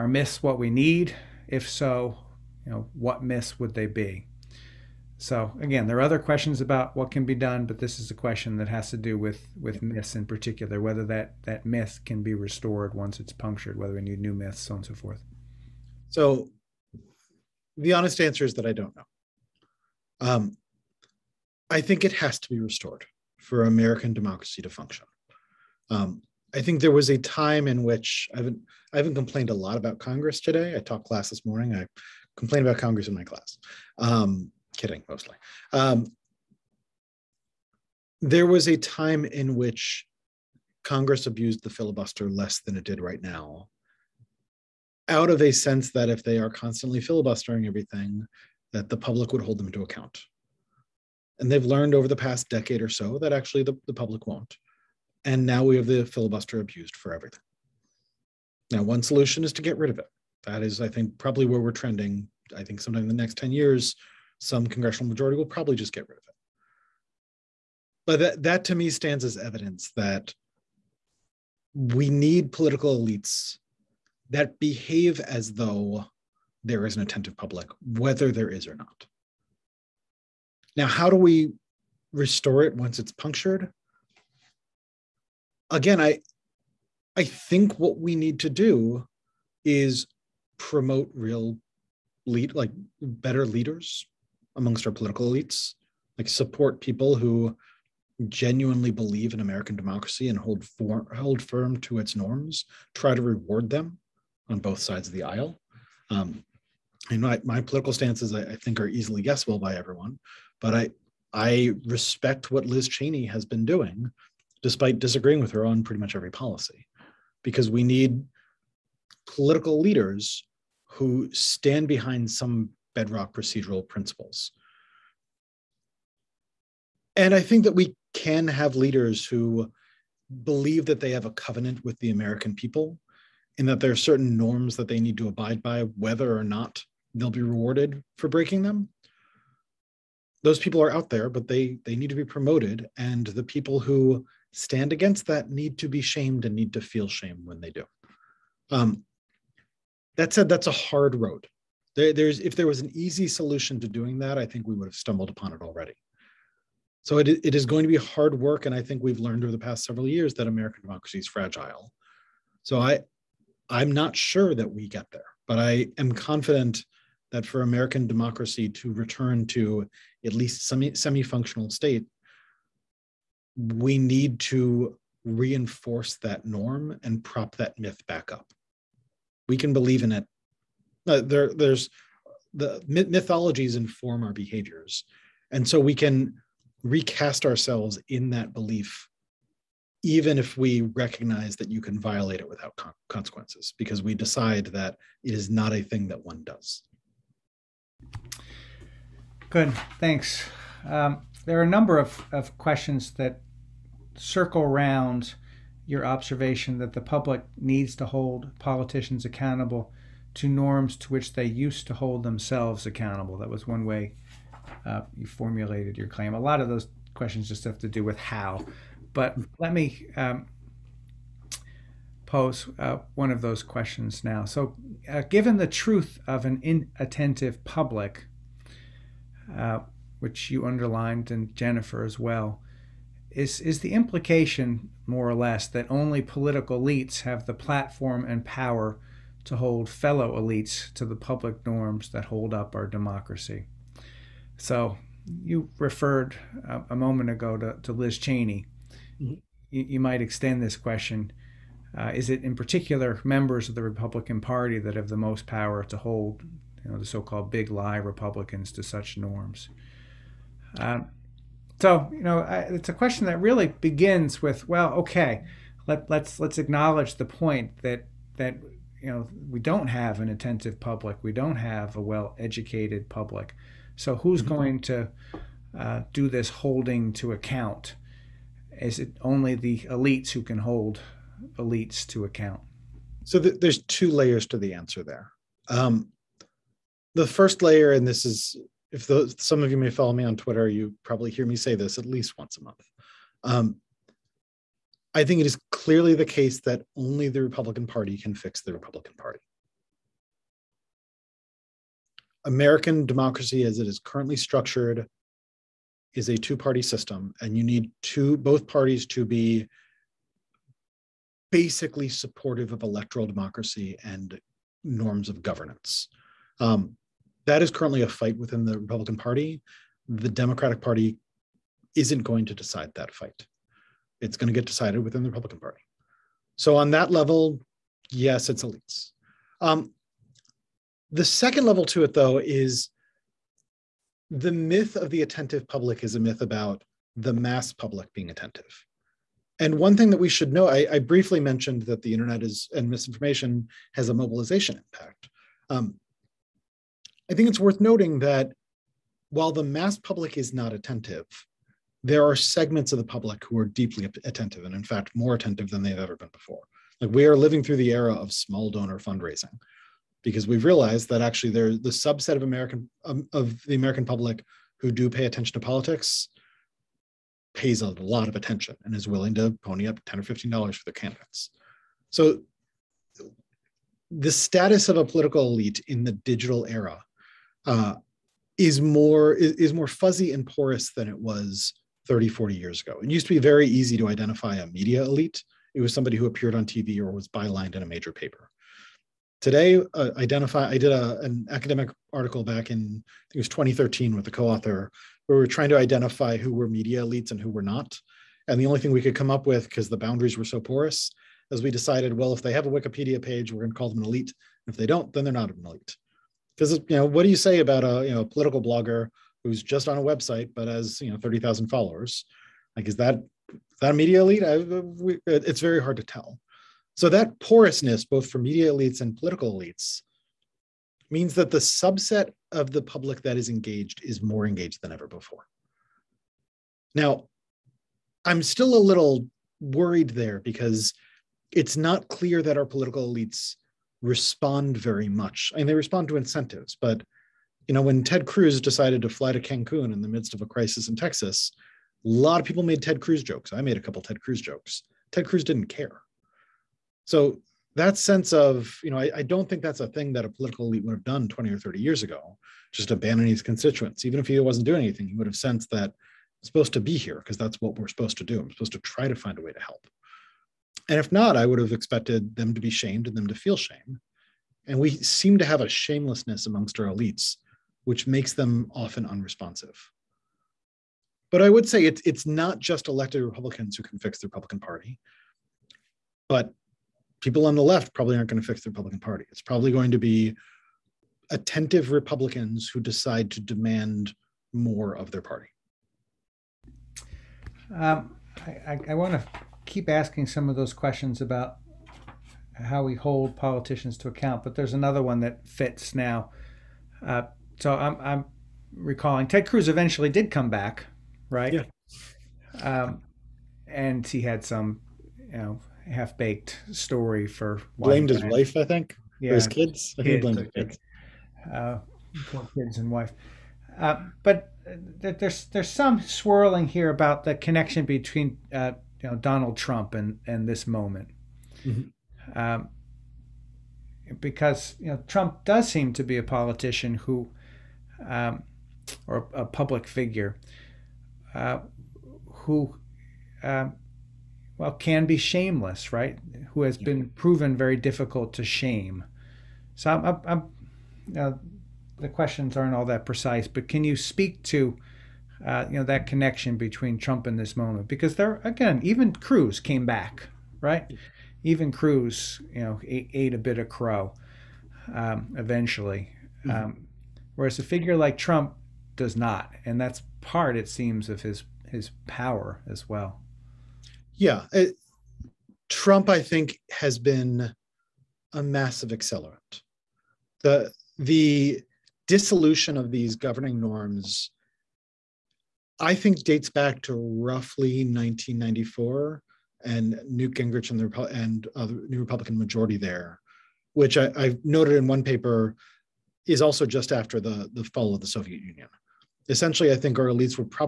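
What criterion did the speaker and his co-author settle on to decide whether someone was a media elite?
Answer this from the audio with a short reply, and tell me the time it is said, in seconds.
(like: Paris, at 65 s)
A Wikipedia page, at 402 s.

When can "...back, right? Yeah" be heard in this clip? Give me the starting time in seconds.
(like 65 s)
500 s.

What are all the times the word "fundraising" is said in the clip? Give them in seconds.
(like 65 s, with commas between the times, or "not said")
358 s.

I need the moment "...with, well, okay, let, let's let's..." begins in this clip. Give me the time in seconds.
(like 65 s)
264 s.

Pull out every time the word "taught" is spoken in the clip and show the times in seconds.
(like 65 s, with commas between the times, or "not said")
30 s.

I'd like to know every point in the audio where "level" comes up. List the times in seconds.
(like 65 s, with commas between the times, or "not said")
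327 s, 331 s.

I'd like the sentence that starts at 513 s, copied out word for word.
Uh, but there's there's some swirling here about the connection between uh, you know Donald Trump and and this moment, mm-hmm.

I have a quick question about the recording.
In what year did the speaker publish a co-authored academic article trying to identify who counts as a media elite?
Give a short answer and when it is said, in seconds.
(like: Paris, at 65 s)
2013, at 393 s.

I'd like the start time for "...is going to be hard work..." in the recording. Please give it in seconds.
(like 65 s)
157 s.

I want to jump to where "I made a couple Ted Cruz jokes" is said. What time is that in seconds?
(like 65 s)
443 s.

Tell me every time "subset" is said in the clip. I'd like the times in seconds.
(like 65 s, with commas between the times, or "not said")
361 s, 421 s.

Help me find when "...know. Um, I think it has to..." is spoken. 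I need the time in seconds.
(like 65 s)
18 s.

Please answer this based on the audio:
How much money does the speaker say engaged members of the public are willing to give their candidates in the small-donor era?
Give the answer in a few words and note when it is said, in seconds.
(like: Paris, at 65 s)
10 or 15 dollars, at 370 s.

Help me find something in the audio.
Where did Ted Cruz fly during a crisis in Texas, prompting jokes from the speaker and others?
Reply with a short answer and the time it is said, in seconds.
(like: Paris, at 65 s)
Cancun, at 439 s.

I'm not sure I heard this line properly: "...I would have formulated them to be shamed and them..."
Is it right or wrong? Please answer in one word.
wrong.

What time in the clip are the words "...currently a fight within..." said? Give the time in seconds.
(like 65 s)
317 s.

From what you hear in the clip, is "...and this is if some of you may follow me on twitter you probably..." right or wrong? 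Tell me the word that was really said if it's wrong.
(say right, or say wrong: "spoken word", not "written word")
right.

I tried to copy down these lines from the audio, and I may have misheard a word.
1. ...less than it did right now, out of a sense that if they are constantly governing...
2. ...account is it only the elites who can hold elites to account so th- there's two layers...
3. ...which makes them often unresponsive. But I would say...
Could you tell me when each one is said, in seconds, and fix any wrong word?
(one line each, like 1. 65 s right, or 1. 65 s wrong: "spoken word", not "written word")
1. 42 s wrong: "filibustering", not "governing"
2. 277 s right
3. 467 s right.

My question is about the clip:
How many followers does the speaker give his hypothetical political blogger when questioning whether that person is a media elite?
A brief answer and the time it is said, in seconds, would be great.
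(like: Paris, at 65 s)
30,000, at 411 s.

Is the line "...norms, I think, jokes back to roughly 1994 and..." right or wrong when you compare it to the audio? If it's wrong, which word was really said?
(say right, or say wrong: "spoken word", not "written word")
wrong: "dates", not "jokes".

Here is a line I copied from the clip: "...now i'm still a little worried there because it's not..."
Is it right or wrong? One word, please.
right.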